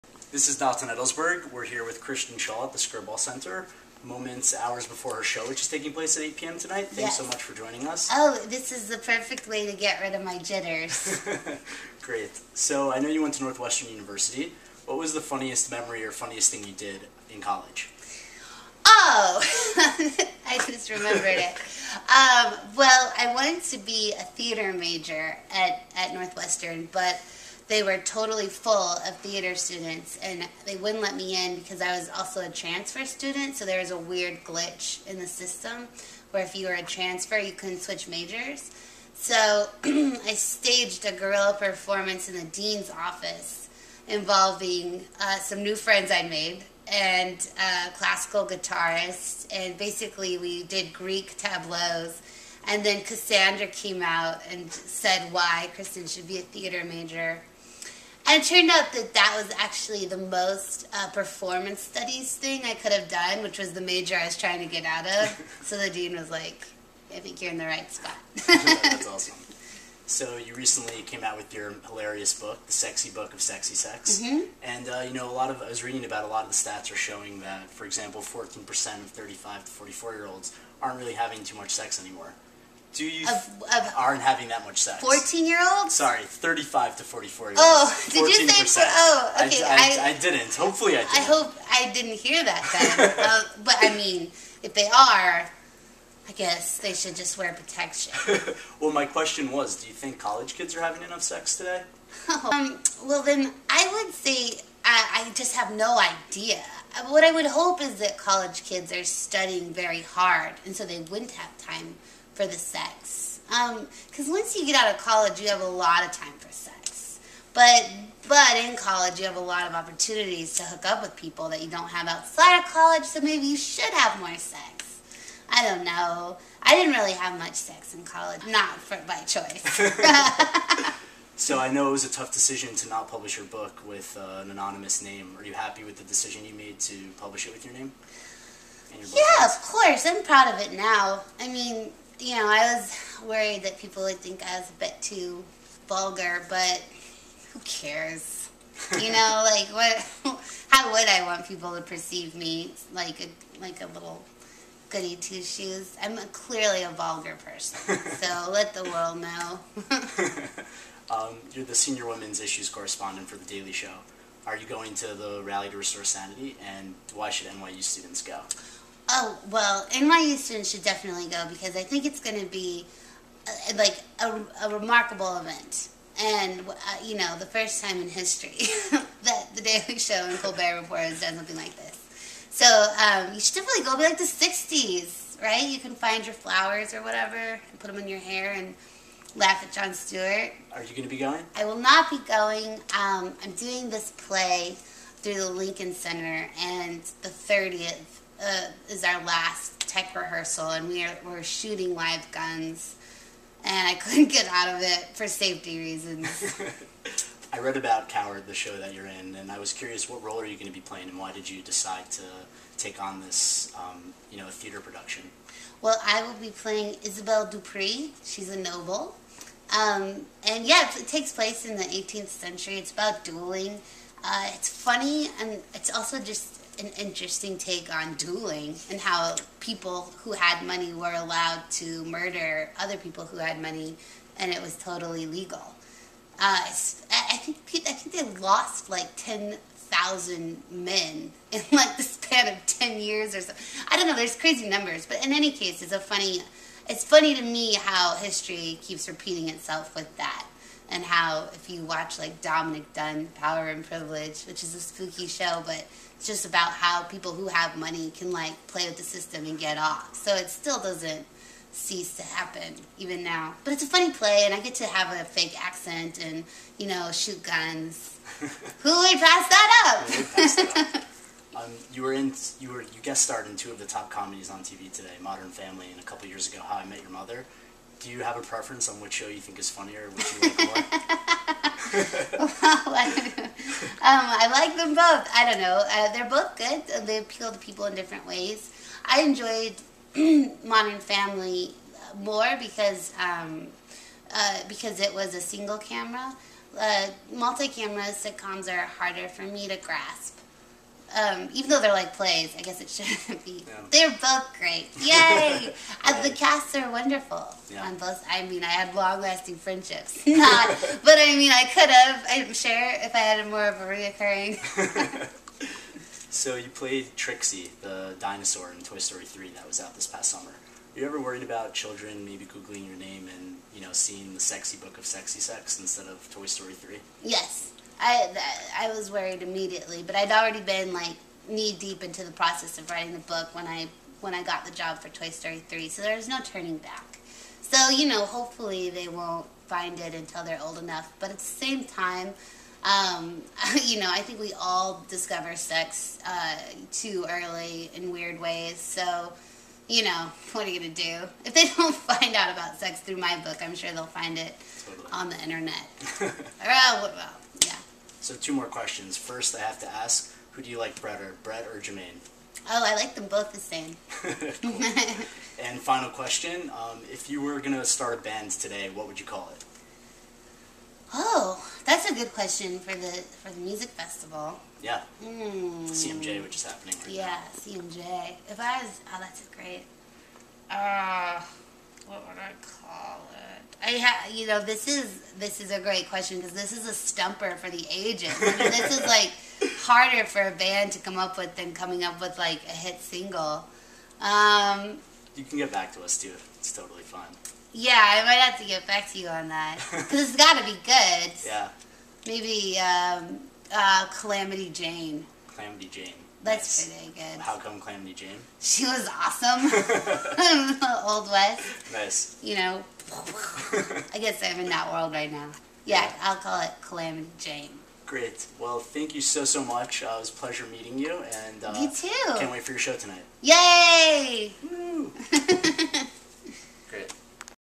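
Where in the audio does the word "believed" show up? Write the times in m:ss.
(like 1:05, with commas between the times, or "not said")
not said.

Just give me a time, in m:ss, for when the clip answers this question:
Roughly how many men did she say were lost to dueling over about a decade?
3:59.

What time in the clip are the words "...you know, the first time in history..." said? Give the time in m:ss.
2:57.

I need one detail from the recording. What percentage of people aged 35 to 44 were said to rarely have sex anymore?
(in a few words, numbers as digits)
14%.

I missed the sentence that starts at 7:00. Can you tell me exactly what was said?
Uh, it was a pleasure meeting you.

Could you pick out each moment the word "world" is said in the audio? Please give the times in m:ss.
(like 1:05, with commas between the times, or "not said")
2:38, 6:54.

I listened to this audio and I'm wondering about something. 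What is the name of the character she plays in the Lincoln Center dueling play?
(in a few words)
Isabel Dupree.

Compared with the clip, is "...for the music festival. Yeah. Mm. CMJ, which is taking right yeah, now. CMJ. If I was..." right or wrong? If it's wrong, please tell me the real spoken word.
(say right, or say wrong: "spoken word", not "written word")
wrong: "happening", not "taking".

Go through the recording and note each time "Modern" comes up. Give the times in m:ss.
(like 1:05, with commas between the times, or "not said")
4:35, 4:50.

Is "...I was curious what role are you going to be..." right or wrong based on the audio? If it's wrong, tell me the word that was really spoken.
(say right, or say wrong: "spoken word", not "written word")
right.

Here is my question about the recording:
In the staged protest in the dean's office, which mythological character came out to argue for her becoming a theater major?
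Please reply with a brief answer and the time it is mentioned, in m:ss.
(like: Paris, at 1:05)
Cassandra, at 0:53.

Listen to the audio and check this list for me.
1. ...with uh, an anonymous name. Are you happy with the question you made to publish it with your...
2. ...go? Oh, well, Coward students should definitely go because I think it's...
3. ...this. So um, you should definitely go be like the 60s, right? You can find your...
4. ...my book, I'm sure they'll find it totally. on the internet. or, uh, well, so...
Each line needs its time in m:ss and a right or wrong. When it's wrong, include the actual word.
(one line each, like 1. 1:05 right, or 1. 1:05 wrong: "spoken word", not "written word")
1. 2:13 wrong: "decision", not "question"
2. 2:48 wrong: "NYU", not "Coward"
3. 3:01 right
4. 5:53 right.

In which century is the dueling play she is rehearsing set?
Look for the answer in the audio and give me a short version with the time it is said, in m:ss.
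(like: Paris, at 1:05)
18th century, at 3:41.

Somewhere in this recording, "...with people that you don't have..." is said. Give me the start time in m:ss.
2:01.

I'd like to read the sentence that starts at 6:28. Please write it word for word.
I mean, this is like harder for a band to come up with than coming up with like a hit single.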